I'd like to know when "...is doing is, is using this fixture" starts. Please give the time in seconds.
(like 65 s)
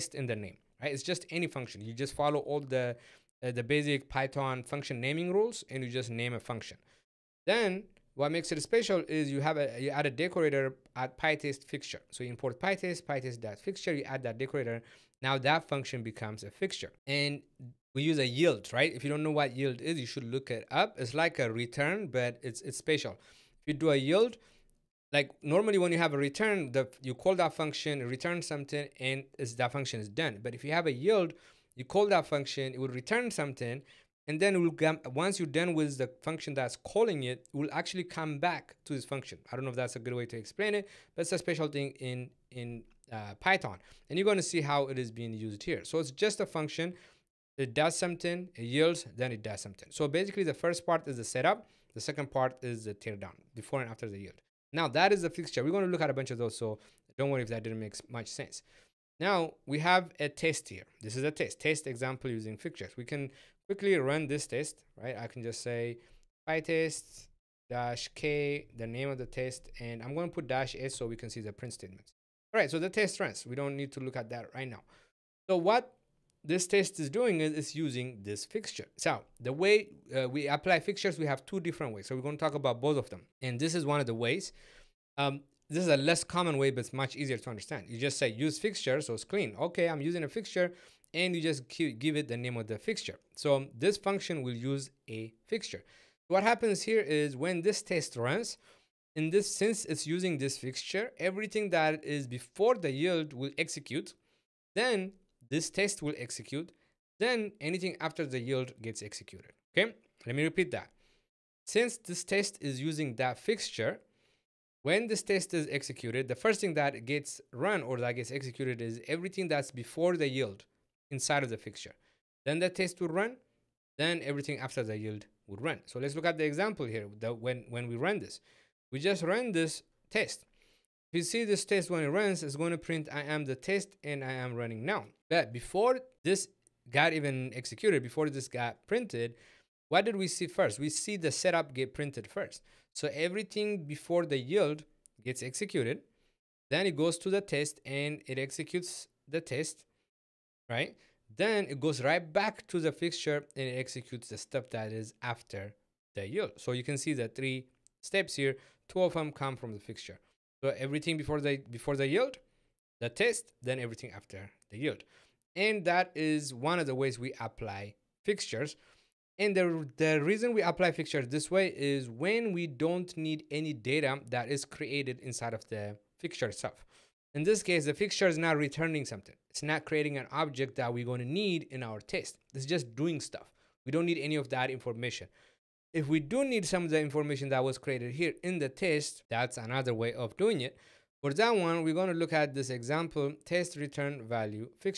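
76 s.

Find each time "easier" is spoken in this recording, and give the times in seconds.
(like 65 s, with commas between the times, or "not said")
87 s.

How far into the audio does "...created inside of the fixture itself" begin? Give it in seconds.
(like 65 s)
174 s.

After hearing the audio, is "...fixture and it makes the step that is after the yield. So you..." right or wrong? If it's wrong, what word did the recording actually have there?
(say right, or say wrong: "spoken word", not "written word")
wrong: "executes", not "makes".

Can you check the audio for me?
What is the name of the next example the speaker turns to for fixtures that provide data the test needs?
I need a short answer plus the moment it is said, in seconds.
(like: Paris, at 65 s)
test return value, at 193 s.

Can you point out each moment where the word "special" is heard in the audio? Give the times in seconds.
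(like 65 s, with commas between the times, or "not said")
8 s, 22 s, 41 s.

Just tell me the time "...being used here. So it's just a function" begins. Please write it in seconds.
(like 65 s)
45 s.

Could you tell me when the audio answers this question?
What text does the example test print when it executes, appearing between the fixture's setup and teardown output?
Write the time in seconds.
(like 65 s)
133 s.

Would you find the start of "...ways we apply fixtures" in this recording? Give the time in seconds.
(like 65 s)
166 s.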